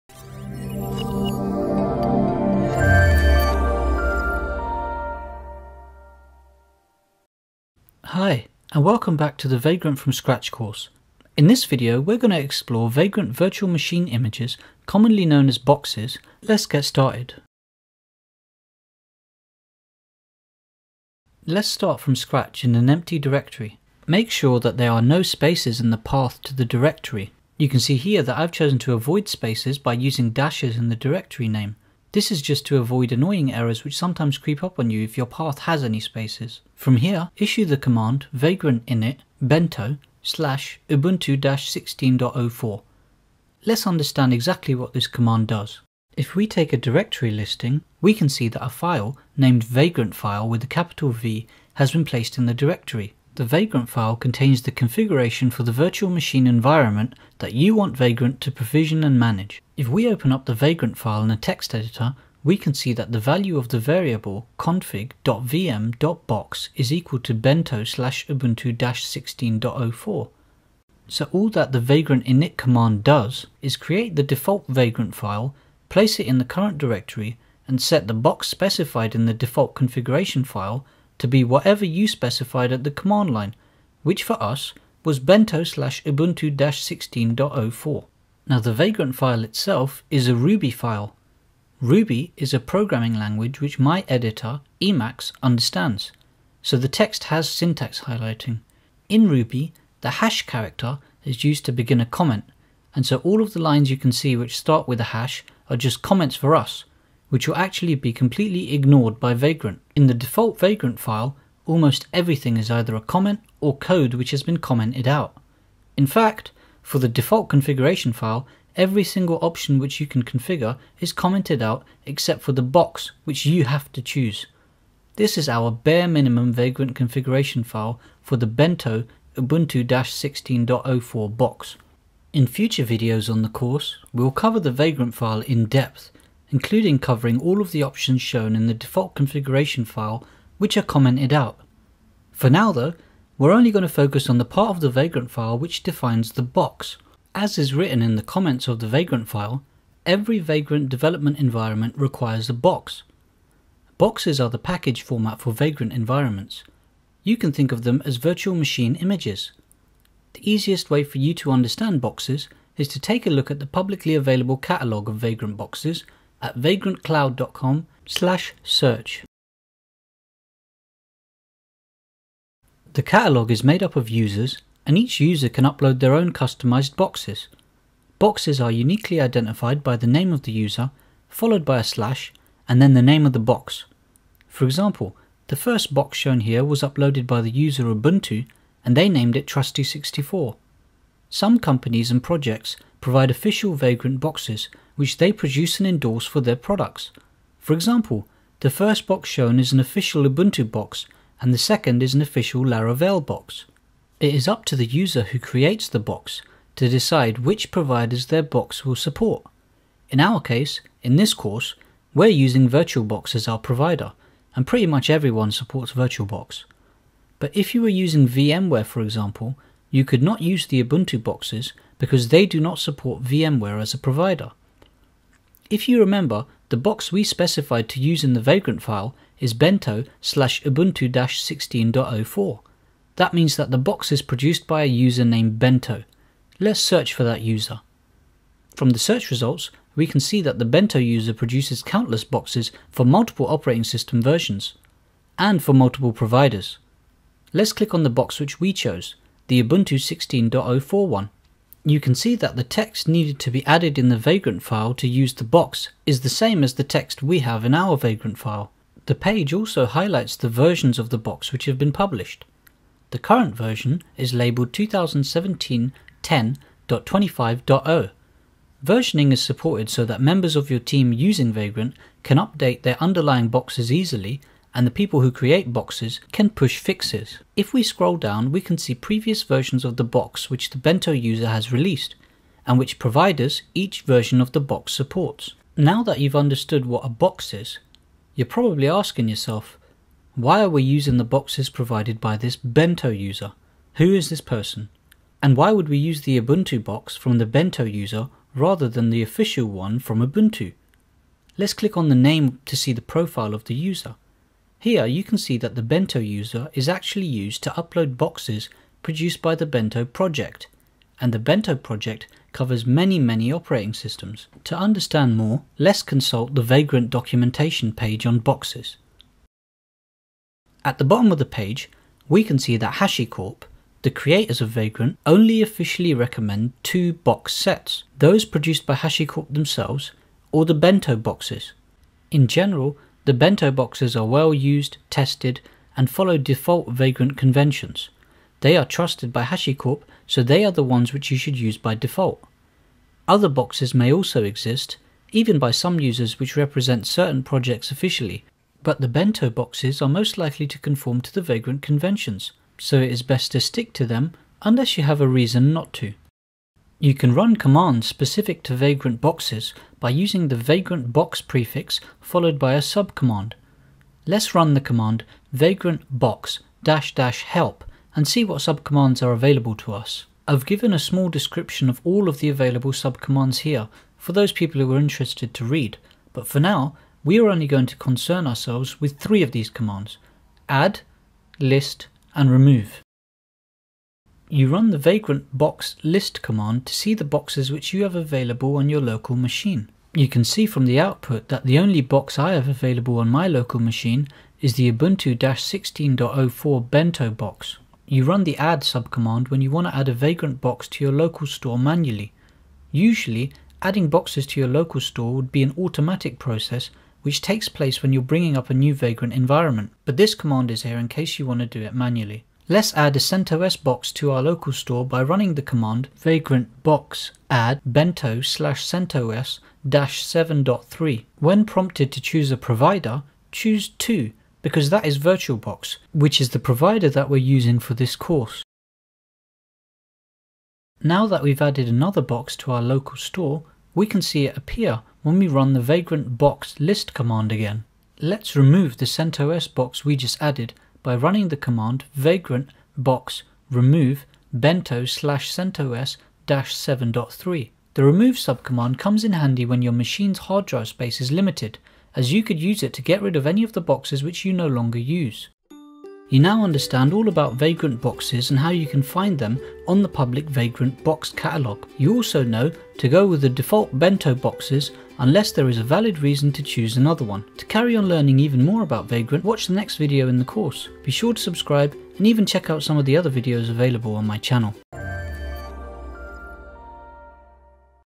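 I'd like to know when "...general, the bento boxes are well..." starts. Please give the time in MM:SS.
05:32.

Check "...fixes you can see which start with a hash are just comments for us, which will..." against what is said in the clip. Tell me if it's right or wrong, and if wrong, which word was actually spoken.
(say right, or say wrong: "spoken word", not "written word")
wrong: "lines", not "fixes".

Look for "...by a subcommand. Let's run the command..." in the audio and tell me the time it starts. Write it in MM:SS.
06:02.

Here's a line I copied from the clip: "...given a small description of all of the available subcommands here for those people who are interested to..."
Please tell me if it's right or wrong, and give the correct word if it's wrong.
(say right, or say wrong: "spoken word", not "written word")
right.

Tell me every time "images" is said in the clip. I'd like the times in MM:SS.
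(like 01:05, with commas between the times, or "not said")
00:14, 02:38.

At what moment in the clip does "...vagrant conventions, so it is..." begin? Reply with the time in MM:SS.
05:51.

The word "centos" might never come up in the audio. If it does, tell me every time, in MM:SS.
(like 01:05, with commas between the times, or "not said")
06:53, 06:58, 07:19, 07:25.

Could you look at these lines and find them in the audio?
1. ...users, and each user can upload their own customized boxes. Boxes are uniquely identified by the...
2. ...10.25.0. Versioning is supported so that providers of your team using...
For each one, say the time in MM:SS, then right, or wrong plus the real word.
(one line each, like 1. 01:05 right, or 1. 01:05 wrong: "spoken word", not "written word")
1. 02:54 right
2. 04:26 wrong: "members", not "providers".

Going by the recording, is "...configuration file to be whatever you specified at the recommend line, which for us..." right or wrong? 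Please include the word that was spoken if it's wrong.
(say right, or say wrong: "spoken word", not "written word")
wrong: "command", not "recommend".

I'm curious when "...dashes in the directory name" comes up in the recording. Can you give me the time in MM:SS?
00:30.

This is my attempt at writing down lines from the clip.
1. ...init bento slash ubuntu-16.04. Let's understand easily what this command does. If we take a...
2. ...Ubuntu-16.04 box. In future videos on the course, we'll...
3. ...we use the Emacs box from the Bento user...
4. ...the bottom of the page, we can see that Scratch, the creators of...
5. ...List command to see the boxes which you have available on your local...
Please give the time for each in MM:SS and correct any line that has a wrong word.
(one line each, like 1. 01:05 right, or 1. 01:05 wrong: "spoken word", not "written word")
1. 00:38 wrong: "exactly", not "easily"
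2. 02:09 right
3. 04:55 wrong: "Ubuntu", not "Emacs"
4. 05:20 wrong: "HashiCorp", not "Scratch"
5. 06:26 right.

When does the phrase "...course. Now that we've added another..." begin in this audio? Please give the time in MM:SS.
07:08.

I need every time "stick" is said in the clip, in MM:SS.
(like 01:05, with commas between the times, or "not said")
05:53.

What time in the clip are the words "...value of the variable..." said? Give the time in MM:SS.
01:03.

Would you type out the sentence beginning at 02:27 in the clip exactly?
As is written in the comments of the Vagrant file, every Vagrant development environment requires a box.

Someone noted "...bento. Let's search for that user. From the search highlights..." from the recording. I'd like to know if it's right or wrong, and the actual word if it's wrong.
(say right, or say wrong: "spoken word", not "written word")
wrong: "results", not "highlights".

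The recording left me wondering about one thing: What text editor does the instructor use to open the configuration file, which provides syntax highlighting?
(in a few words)
Emacs.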